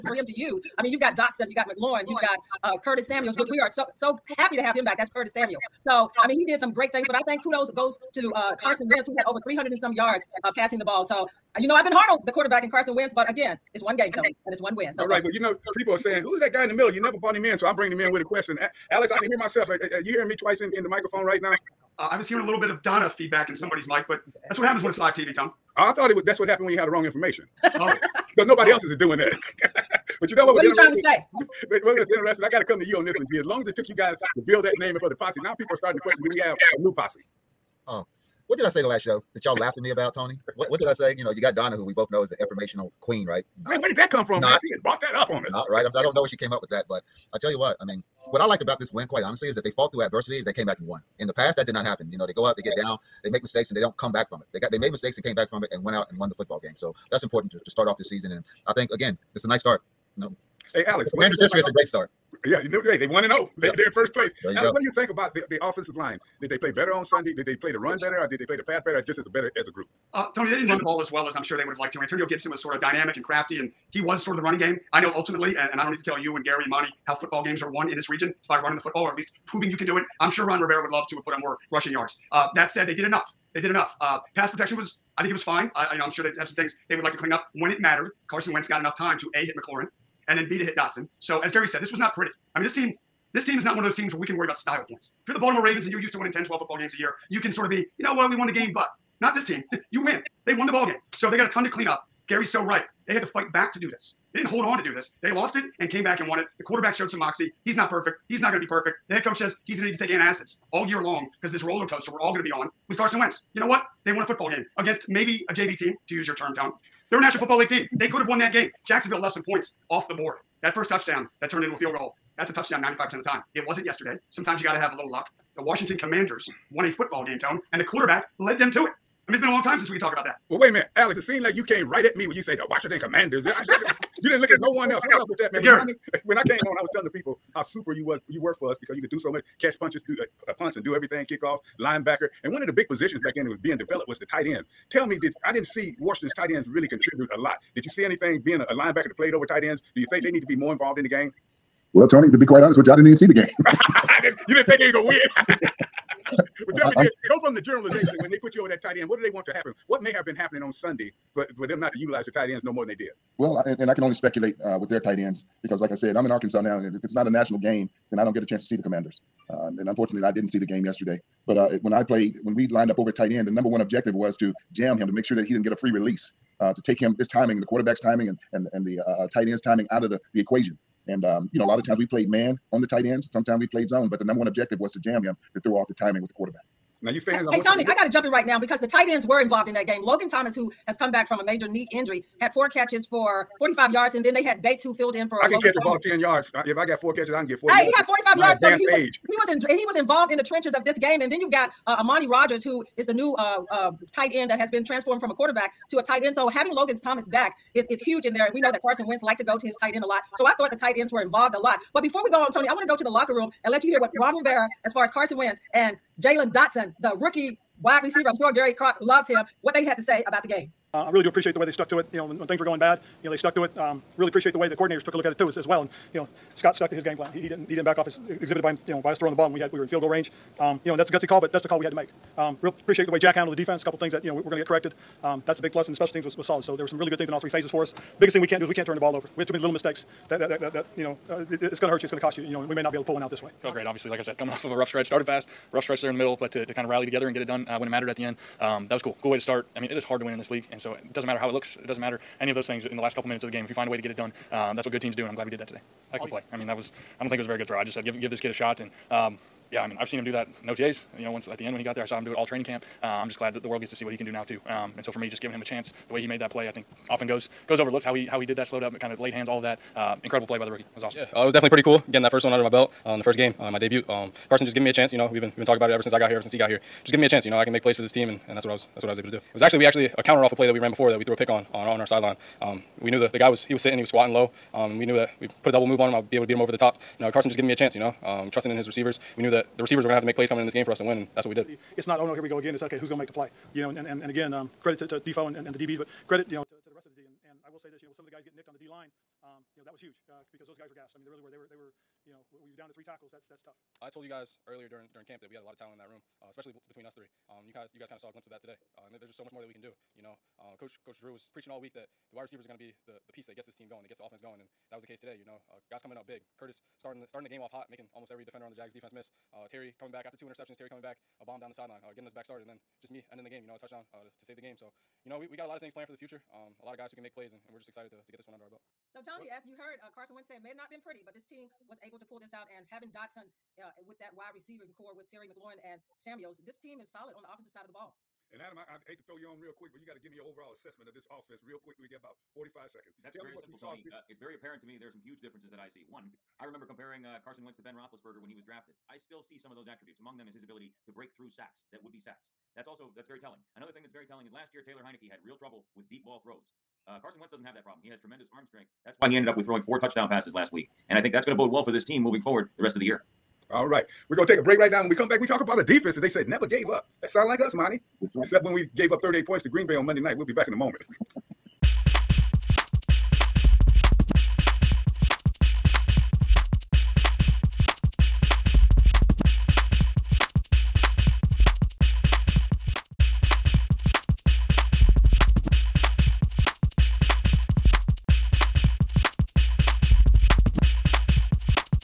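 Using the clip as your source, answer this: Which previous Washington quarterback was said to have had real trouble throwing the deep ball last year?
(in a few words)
Taylor Heinicke.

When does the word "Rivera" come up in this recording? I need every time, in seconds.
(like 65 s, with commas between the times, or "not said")
80 s, 214 s.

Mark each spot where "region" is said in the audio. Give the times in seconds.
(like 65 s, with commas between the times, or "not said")
78 s.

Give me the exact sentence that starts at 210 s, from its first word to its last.
So I thought the tight ends were involved a lot.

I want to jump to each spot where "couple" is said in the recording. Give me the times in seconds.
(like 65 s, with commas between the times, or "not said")
233 s, 253 s.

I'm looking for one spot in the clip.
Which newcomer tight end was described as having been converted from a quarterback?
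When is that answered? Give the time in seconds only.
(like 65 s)
202 s.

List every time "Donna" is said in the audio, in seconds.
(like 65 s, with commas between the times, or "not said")
22 s, 41 s.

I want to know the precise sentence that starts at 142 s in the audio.
And one of the big positions back then that was being developed was the tight ends.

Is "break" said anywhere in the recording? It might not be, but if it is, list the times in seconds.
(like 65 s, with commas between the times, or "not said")
351 s, 364 s.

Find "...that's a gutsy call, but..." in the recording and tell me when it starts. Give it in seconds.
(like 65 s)
230 s.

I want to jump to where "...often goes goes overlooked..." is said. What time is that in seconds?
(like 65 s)
267 s.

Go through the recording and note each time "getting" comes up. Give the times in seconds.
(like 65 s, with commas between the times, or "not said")
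272 s, 298 s, 322 s.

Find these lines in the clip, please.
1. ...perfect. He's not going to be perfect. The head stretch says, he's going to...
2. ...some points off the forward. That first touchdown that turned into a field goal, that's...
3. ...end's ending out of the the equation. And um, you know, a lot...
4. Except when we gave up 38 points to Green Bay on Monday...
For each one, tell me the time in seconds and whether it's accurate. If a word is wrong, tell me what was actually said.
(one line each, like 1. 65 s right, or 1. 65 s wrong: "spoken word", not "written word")
1. 107 s wrong: "coach", not "stretch"
2. 119 s wrong: "board", not "forward"
3. 179 s wrong: "timing", not "ending"
4. 368 s right.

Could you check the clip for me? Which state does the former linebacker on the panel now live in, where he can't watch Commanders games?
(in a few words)
Arkansas.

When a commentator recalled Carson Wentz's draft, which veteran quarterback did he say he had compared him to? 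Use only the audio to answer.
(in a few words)
Ben Roethlisberger.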